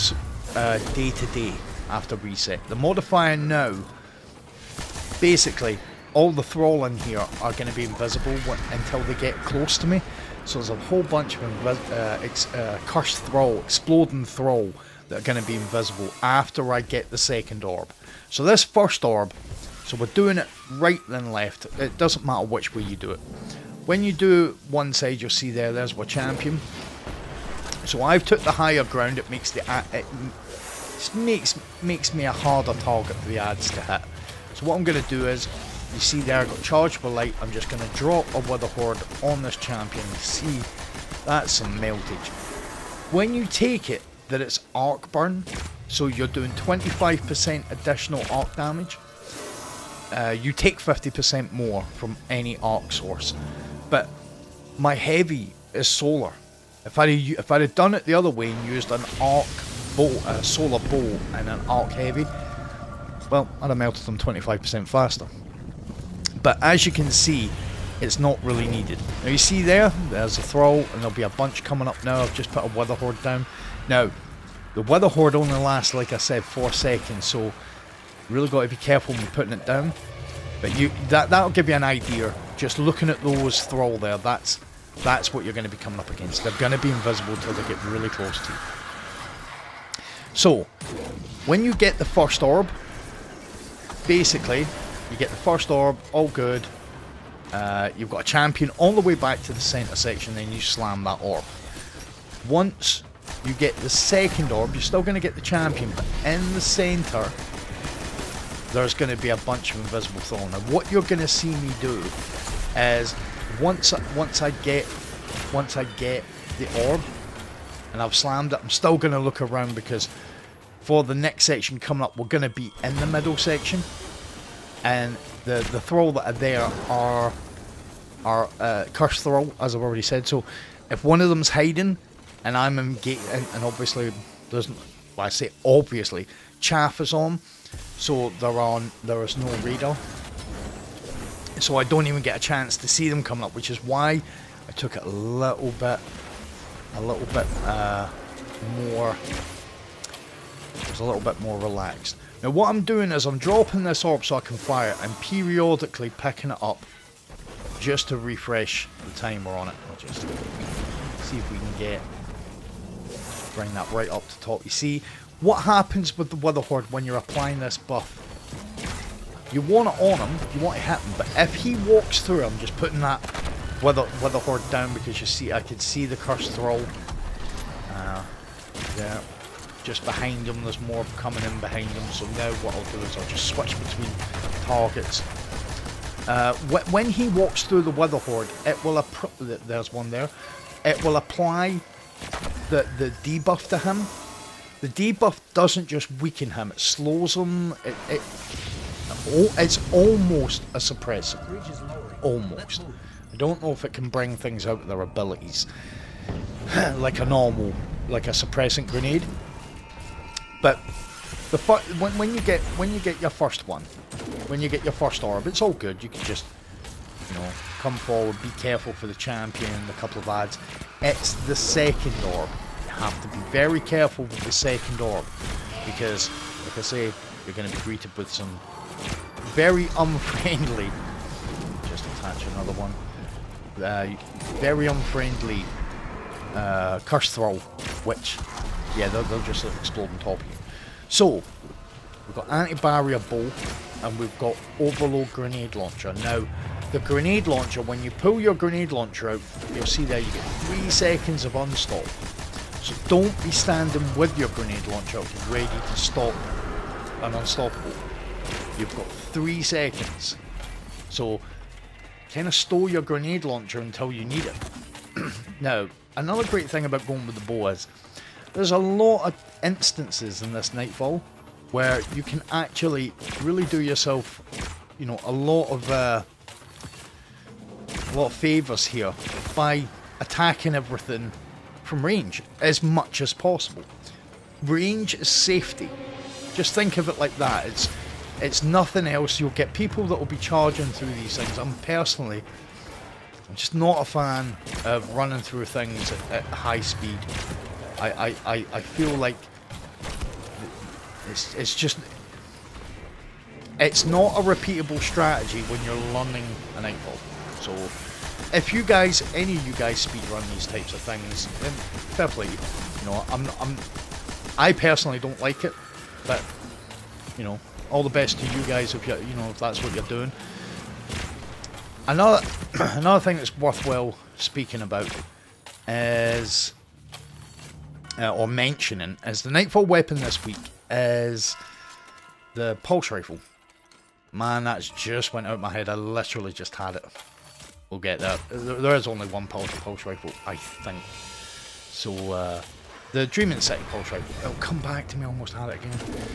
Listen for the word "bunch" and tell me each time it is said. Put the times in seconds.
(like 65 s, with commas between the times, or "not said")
11 s, 71 s, 109 s.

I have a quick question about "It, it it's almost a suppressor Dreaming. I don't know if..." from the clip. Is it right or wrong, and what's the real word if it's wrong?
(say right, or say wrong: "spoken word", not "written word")
wrong: "Almost", not "Dreaming".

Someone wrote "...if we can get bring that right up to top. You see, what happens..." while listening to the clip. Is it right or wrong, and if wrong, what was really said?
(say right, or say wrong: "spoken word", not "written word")
right.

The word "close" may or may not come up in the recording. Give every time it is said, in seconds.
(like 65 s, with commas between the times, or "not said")
9 s, 88 s.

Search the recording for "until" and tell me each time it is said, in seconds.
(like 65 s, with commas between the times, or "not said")
8 s, 87 s, 263 s.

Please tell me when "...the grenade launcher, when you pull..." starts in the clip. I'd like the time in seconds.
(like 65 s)
246 s.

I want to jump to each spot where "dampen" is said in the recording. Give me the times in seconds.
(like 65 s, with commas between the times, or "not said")
not said.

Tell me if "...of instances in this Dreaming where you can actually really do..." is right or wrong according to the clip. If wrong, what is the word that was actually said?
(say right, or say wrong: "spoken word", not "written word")
wrong: "Nightfall", not "Dreaming".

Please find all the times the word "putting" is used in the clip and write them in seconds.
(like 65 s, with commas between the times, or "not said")
79 s, 172 s.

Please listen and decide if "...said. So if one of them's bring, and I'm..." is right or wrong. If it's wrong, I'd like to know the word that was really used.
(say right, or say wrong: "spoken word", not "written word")
wrong: "hiding", not "bring".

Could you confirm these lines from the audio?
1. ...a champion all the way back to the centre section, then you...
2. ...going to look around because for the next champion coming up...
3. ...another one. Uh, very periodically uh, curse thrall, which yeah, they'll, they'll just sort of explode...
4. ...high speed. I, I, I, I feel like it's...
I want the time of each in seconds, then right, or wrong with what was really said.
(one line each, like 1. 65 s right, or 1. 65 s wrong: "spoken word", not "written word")
1. 98 s right
2. 118 s wrong: "section", not "champion"
3. 232 s wrong: "unfriendly", not "periodically"
4. 296 s right.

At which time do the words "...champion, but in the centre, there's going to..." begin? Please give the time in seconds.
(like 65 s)
105 s.